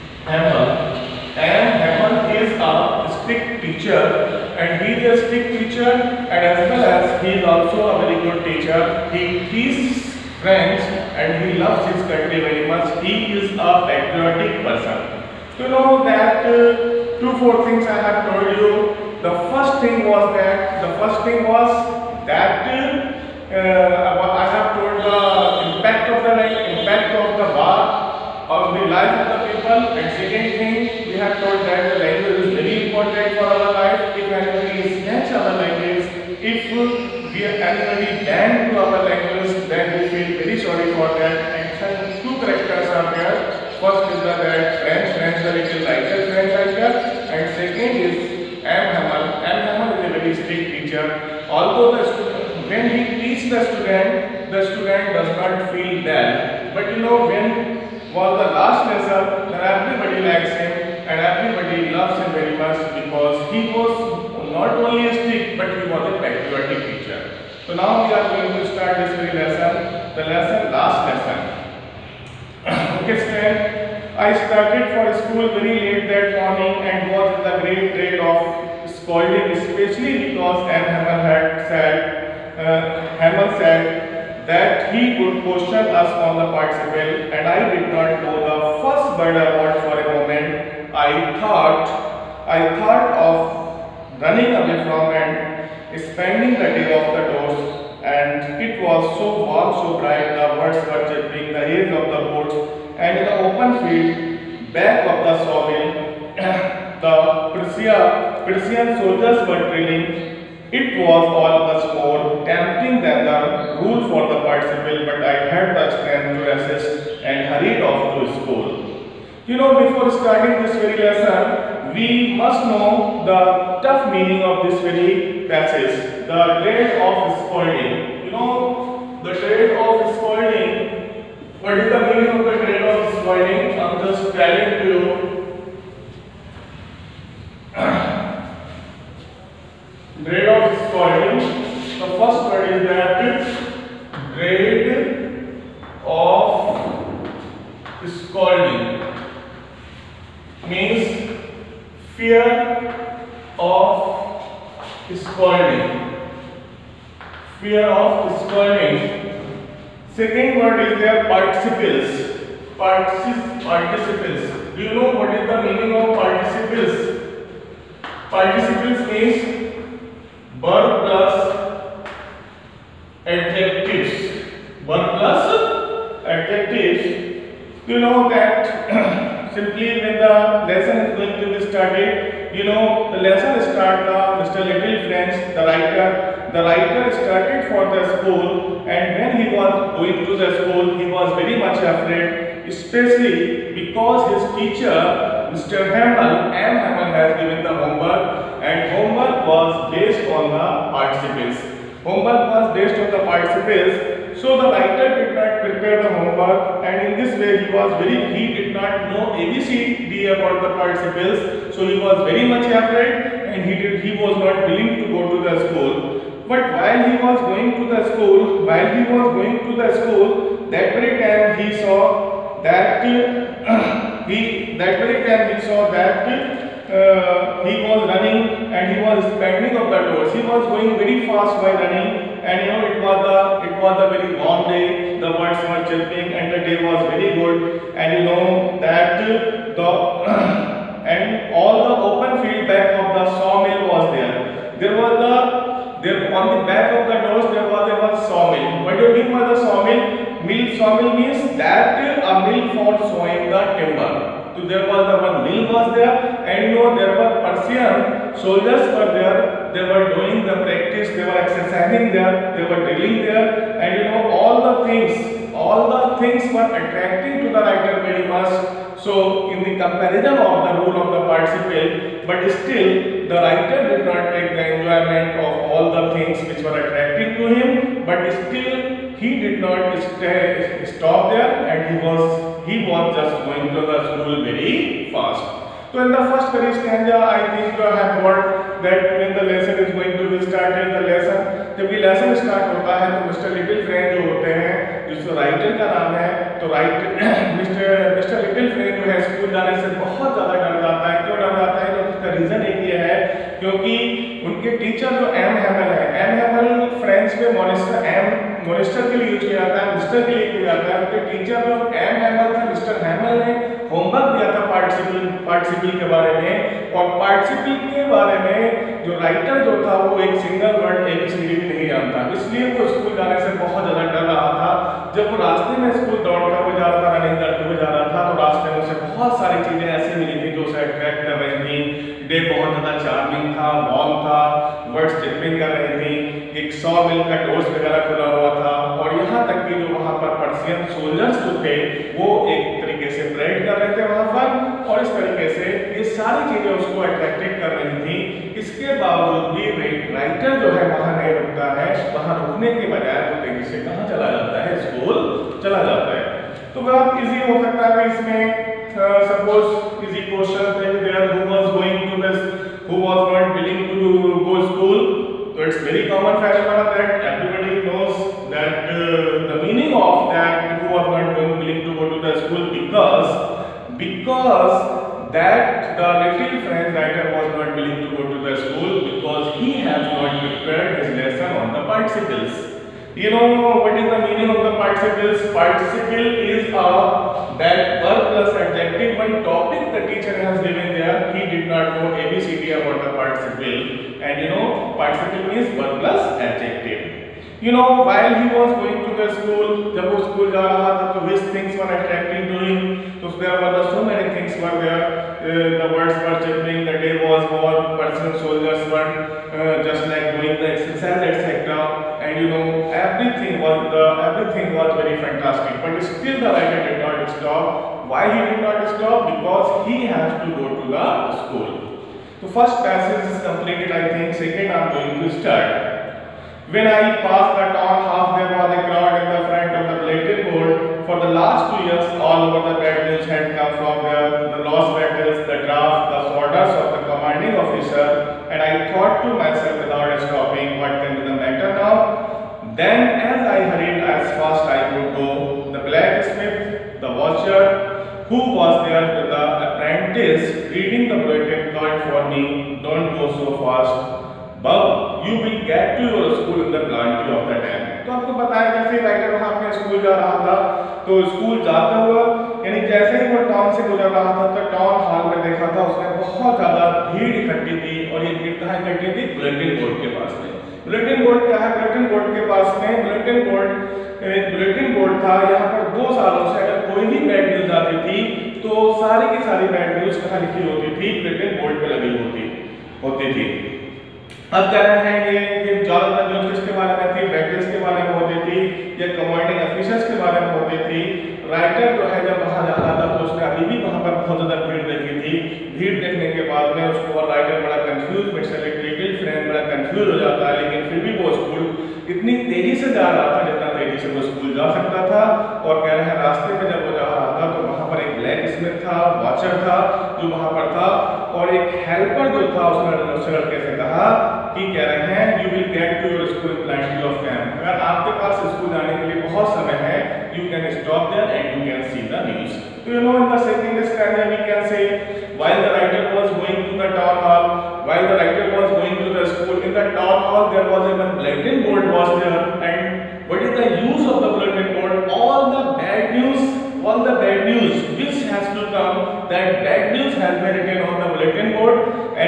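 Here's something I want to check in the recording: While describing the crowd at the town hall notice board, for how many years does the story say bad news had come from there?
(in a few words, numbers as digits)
2.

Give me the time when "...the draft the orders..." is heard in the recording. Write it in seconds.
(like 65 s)
435 s.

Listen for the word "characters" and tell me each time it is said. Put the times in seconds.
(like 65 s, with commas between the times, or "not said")
42 s, 46 s.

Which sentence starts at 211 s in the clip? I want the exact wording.
So he was very much afraid and he did, he was not willing to go to the school.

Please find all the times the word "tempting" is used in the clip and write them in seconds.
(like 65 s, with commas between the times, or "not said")
112 s.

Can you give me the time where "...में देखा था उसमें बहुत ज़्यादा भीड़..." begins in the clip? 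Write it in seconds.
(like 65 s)
465 s.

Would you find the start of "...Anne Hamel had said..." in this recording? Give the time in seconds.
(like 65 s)
80 s.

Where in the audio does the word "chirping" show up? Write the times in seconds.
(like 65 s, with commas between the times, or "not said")
101 s, 235 s.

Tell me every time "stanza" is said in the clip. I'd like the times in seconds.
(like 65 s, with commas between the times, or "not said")
286 s, 523 s.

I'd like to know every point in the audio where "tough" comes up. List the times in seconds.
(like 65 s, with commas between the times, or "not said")
123 s.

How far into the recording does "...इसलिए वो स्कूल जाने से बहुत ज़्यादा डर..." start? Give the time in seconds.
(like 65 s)
322 s.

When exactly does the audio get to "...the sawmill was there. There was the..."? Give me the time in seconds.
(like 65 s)
243 s.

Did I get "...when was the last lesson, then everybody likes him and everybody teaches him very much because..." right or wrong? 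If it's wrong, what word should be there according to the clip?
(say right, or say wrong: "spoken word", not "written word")
wrong: "loves", not "teaches".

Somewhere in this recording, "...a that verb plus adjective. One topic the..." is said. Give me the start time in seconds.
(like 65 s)
386 s.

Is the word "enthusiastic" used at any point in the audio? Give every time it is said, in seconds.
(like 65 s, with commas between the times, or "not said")
5 s.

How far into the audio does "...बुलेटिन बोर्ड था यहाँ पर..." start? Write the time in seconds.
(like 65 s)
474 s.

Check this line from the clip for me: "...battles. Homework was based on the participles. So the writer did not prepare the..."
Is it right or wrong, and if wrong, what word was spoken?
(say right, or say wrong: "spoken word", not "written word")
wrong: "participles", not "battles".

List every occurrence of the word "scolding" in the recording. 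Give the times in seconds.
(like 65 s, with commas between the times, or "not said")
78 s.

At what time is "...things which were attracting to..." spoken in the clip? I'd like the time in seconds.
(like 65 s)
276 s.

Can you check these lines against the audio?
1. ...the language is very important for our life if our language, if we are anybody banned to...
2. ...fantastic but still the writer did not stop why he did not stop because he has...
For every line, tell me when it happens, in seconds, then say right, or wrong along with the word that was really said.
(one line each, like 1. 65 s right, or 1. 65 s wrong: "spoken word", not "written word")
1. 31 s right
2. 415 s right.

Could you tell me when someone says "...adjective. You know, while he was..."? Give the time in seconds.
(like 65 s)
396 s.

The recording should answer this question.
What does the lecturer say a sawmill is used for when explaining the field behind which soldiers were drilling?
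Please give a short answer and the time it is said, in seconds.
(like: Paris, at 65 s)
Sawing the timber, at 253 s.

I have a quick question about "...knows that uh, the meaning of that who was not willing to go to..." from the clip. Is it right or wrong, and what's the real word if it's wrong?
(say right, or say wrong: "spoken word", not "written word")
right.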